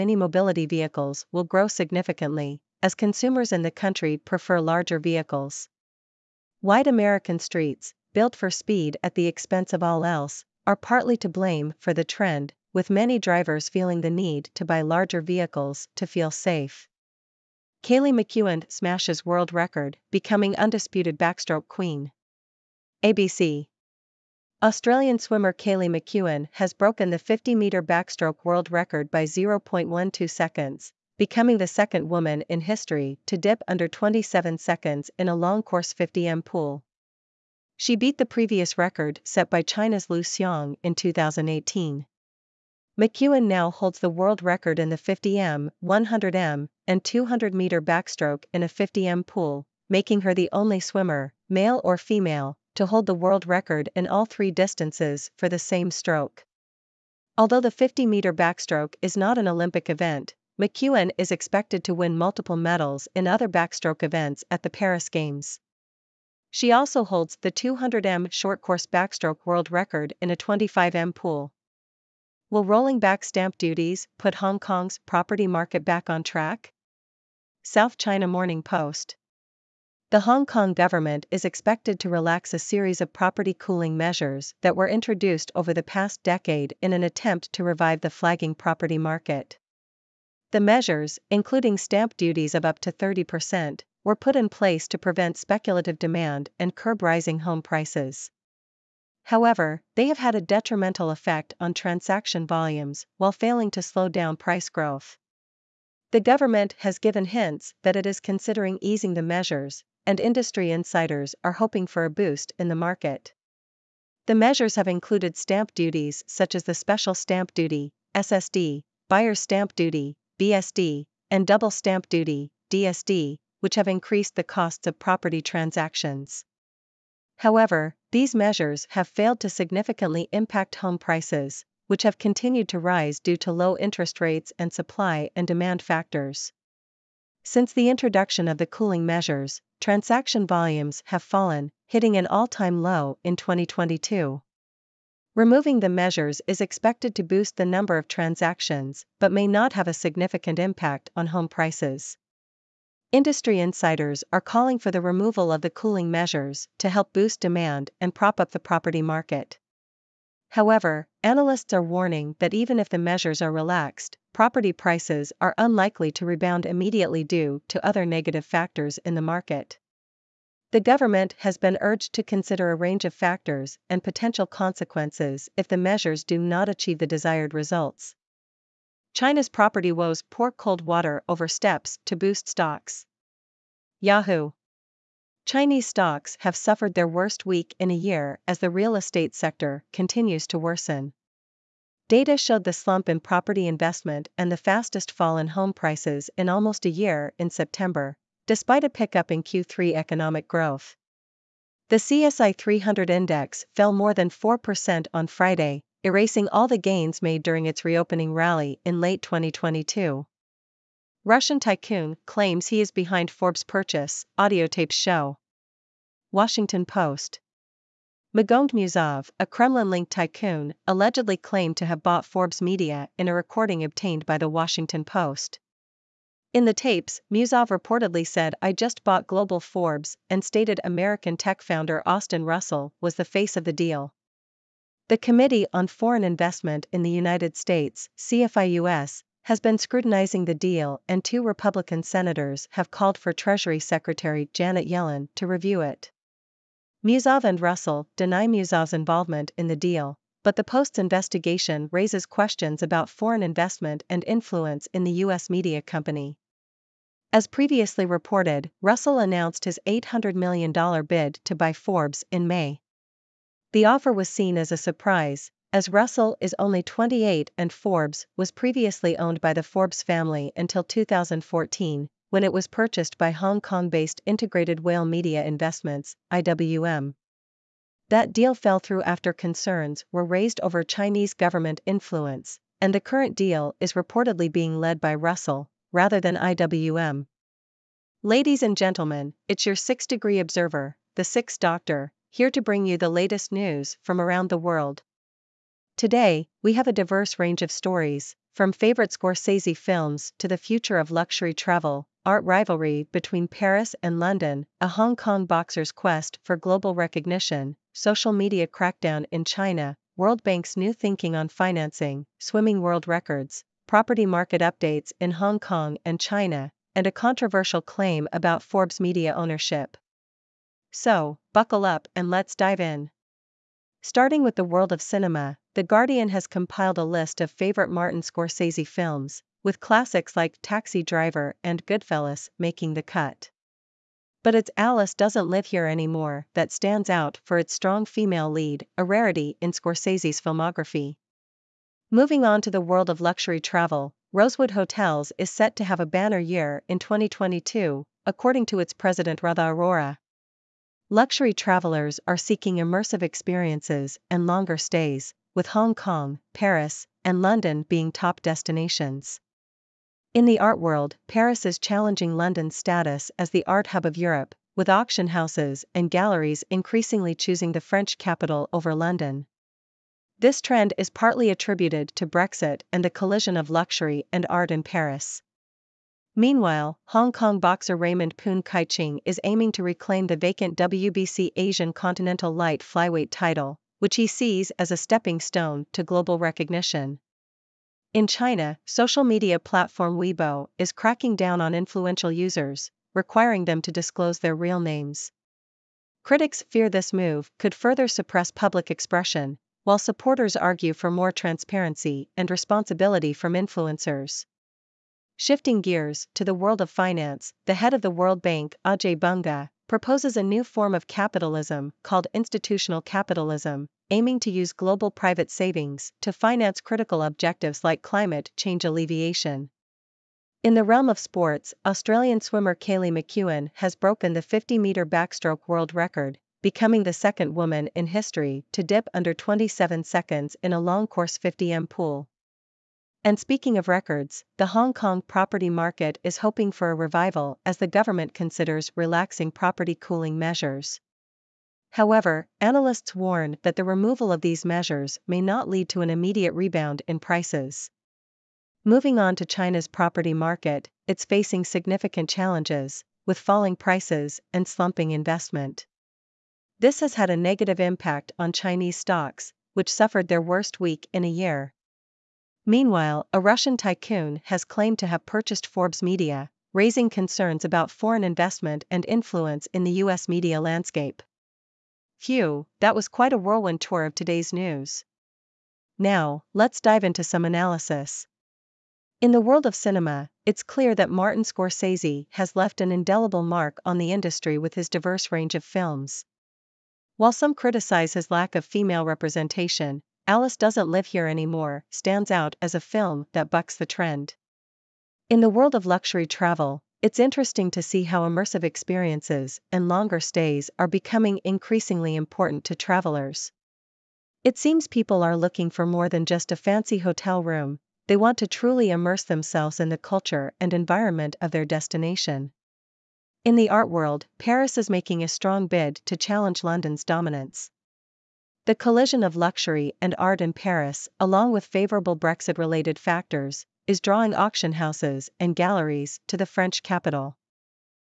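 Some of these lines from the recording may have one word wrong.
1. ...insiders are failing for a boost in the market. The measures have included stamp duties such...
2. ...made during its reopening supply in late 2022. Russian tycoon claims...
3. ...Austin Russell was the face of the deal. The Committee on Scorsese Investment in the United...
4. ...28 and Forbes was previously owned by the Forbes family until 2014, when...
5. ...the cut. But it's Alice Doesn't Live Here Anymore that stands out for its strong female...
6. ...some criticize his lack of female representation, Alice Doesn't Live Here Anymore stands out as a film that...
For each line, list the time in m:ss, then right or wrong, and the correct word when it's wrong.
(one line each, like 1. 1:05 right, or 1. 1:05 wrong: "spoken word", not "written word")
1. 1:50 wrong: "hoping", not "failing"
2. 3:27 wrong: "rally", not "supply"
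3. 3:52 wrong: "Foreign", not "Scorsese"
4. 4:26 right
5. 5:32 right
6. 8:07 right.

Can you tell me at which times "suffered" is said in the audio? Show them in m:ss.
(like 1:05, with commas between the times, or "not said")
3:06, 7:39.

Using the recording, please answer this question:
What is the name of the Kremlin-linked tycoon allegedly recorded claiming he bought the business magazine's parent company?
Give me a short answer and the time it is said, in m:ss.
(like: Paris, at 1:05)
Magomed Musaev, at 3:38.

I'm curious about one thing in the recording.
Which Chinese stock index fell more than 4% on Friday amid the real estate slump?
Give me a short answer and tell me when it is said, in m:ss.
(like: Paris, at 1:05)
CSI 300, at 3:21.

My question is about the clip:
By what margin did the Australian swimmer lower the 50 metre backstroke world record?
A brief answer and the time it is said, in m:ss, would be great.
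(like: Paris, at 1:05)
0.12 seconds, at 0:29.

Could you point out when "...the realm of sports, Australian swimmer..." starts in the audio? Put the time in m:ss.
7:00.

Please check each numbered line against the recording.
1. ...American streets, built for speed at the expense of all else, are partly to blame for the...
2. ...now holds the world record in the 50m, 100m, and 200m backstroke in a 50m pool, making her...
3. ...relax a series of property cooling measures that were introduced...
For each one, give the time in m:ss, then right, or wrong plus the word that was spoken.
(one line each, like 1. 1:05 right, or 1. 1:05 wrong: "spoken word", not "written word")
1. 0:06 right
2. 0:43 right
3. 1:22 right.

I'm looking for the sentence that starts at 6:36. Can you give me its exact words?
Critics fear this move could further suppress public expression, while supporters argue for more transparency and responsibility from influencers.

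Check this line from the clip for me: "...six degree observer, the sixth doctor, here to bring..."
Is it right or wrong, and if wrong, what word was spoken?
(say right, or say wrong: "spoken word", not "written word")
right.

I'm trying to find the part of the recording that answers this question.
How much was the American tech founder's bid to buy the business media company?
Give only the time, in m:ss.
4:19.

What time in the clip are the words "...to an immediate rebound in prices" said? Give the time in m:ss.
7:25.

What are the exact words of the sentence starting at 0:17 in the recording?
Kaylee McKeown smashes world record, becoming undisputed backstroke queen.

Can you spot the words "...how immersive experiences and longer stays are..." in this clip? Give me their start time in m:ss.
8:18.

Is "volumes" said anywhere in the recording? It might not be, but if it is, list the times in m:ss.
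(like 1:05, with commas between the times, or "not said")
1:42, 2:20.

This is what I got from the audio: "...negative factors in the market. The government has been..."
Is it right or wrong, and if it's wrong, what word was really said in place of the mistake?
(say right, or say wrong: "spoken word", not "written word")
right.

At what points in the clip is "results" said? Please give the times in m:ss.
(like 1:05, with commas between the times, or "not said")
2:57.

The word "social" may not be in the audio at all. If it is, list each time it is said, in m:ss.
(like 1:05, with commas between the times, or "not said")
5:07, 6:28.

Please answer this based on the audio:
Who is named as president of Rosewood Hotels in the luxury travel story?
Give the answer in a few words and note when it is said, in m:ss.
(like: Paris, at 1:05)
Radha Arora, at 5:49.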